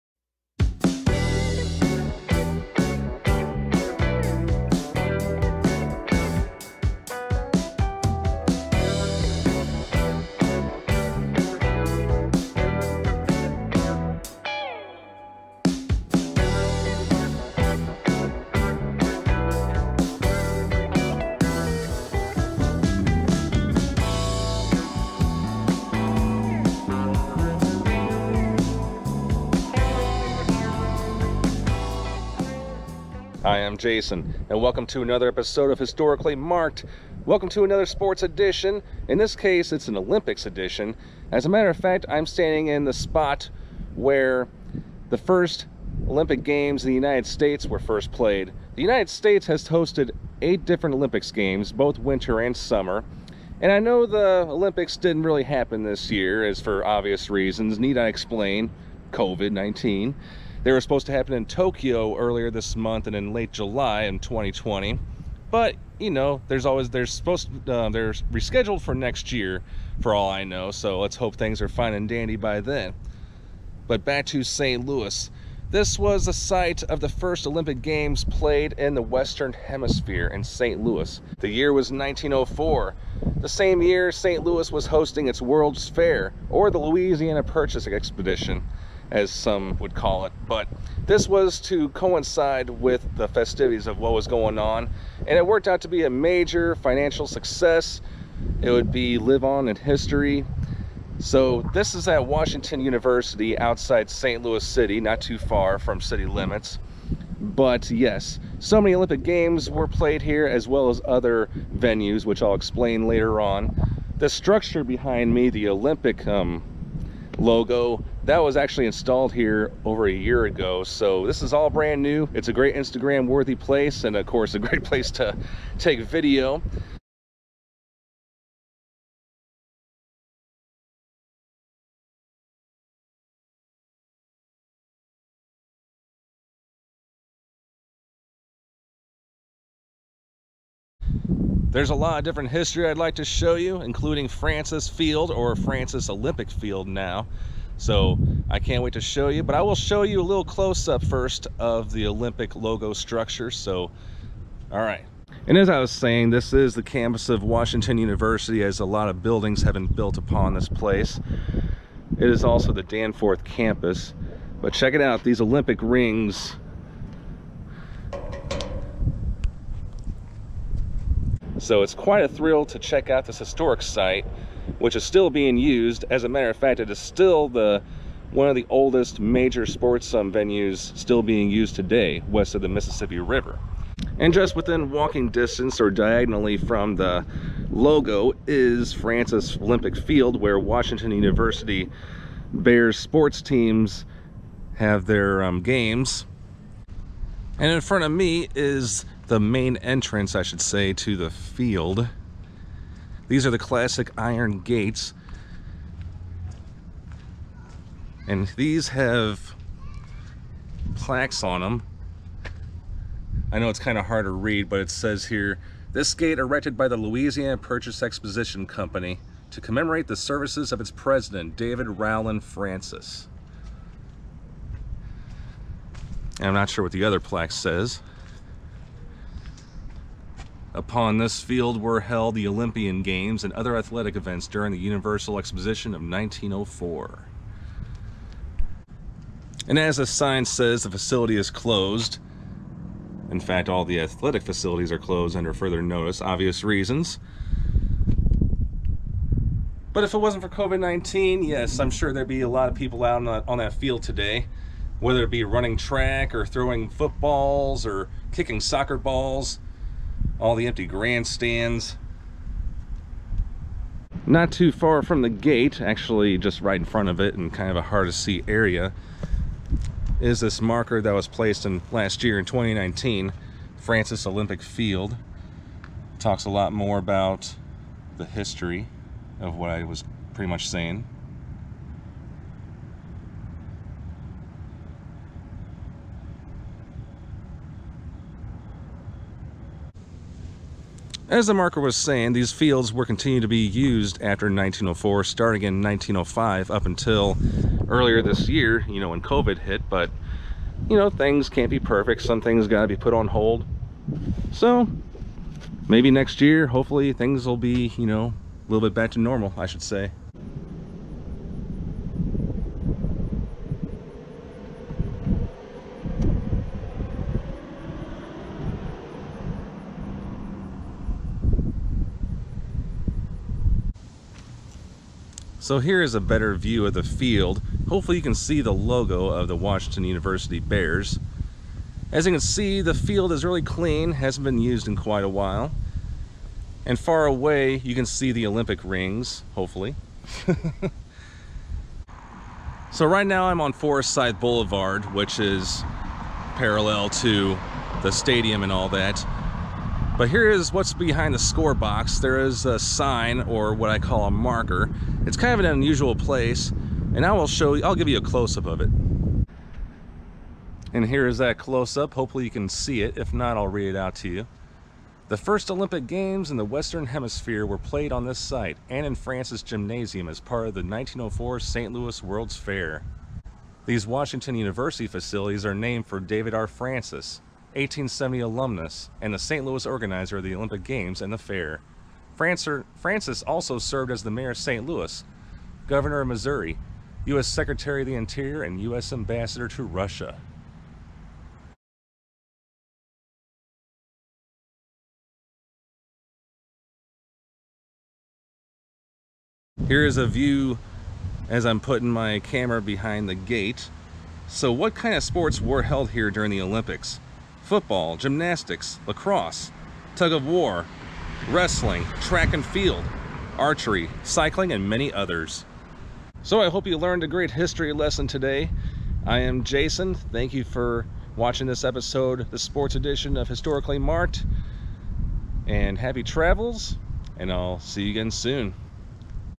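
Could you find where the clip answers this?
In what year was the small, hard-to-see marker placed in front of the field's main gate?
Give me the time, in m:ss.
4:32.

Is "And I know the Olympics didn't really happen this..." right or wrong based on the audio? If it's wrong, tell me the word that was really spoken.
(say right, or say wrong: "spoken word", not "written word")
right.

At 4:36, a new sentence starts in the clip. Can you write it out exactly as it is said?
talks a lot more about the history of what I was pretty much saying.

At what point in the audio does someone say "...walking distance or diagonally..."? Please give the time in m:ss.
3:04.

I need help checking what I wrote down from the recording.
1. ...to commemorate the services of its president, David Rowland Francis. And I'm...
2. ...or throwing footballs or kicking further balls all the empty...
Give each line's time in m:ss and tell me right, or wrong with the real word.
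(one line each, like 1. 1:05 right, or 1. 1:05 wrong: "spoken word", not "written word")
1. 3:39 right
2. 4:16 wrong: "soccer", not "further".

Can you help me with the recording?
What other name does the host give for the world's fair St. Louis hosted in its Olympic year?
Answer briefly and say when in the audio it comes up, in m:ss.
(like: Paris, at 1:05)
Louisiana Purchase Expedition, at 1:26.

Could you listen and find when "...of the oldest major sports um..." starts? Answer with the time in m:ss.
2:58.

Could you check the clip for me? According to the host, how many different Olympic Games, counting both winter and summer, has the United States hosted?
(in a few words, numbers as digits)
8.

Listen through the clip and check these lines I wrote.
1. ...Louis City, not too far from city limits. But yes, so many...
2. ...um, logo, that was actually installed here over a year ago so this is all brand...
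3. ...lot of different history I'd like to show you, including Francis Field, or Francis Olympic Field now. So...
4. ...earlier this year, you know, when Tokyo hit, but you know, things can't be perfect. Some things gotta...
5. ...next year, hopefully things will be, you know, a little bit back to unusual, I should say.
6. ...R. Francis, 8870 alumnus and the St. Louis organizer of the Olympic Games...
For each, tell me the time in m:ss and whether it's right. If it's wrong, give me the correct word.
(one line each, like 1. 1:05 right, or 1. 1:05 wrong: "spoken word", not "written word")
1. 1:44 right
2. 1:56 right
3. 2:21 right
4. 4:57 wrong: "COVID", not "Tokyo"
5. 5:06 wrong: "normal", not "unusual"
6. 6:16 wrong: "1870", not "8870".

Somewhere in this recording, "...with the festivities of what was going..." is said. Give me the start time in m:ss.
1:32.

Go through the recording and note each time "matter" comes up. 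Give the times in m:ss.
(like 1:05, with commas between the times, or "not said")
0:41, 2:56.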